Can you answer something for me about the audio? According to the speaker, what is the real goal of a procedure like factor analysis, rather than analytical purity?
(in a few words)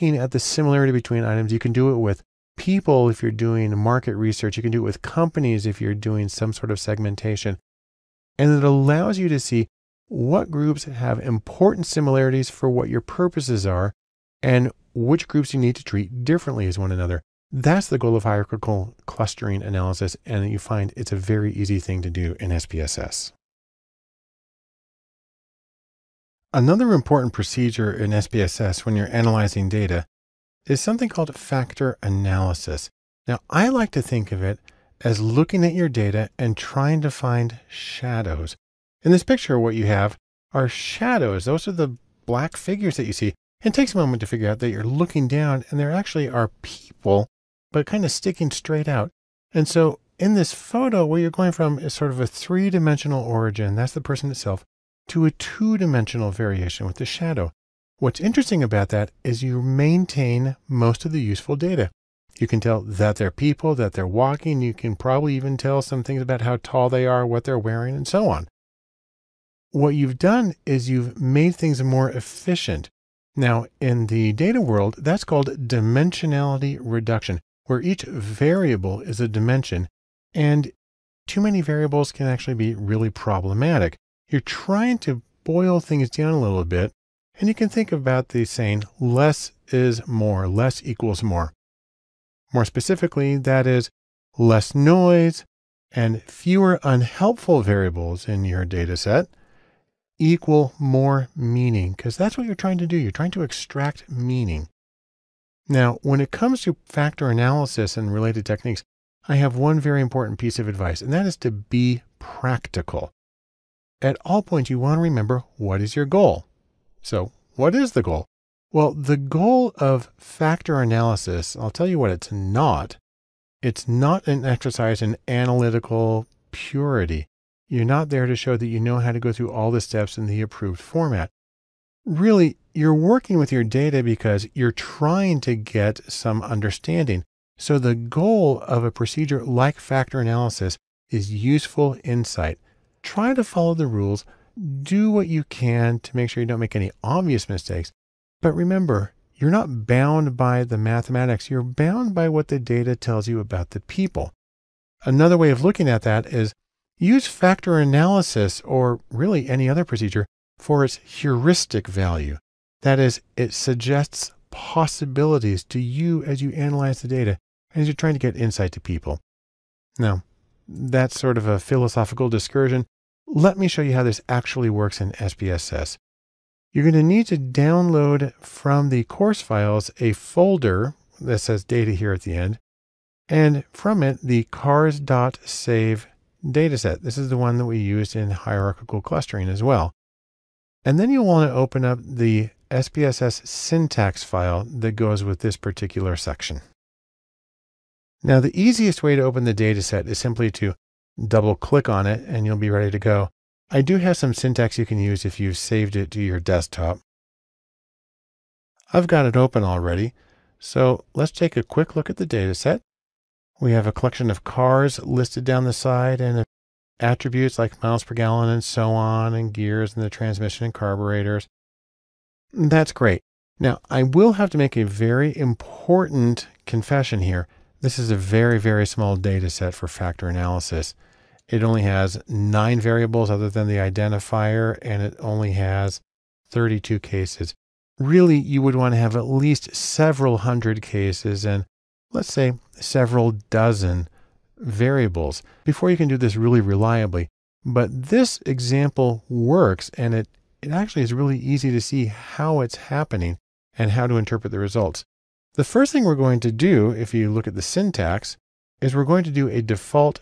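useful insight.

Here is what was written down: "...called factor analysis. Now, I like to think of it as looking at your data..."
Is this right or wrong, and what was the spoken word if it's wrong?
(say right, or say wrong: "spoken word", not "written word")
right.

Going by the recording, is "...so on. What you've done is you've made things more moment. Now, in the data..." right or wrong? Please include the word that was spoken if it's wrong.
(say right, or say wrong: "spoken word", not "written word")
wrong: "efficient", not "moment".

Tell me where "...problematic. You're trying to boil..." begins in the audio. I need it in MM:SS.
01:23.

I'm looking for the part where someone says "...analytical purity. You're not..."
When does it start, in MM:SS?
02:05.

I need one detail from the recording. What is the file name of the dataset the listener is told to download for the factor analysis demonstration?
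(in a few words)
cars.sav.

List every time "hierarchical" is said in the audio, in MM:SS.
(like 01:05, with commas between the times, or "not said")
00:18, 03:08.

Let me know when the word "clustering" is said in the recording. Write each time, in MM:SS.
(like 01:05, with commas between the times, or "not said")
00:19, 03:09.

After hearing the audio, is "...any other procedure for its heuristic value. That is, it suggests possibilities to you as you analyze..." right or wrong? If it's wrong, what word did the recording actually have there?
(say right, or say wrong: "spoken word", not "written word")
right.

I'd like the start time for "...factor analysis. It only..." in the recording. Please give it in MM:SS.
03:49.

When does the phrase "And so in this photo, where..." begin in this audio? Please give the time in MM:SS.
00:49.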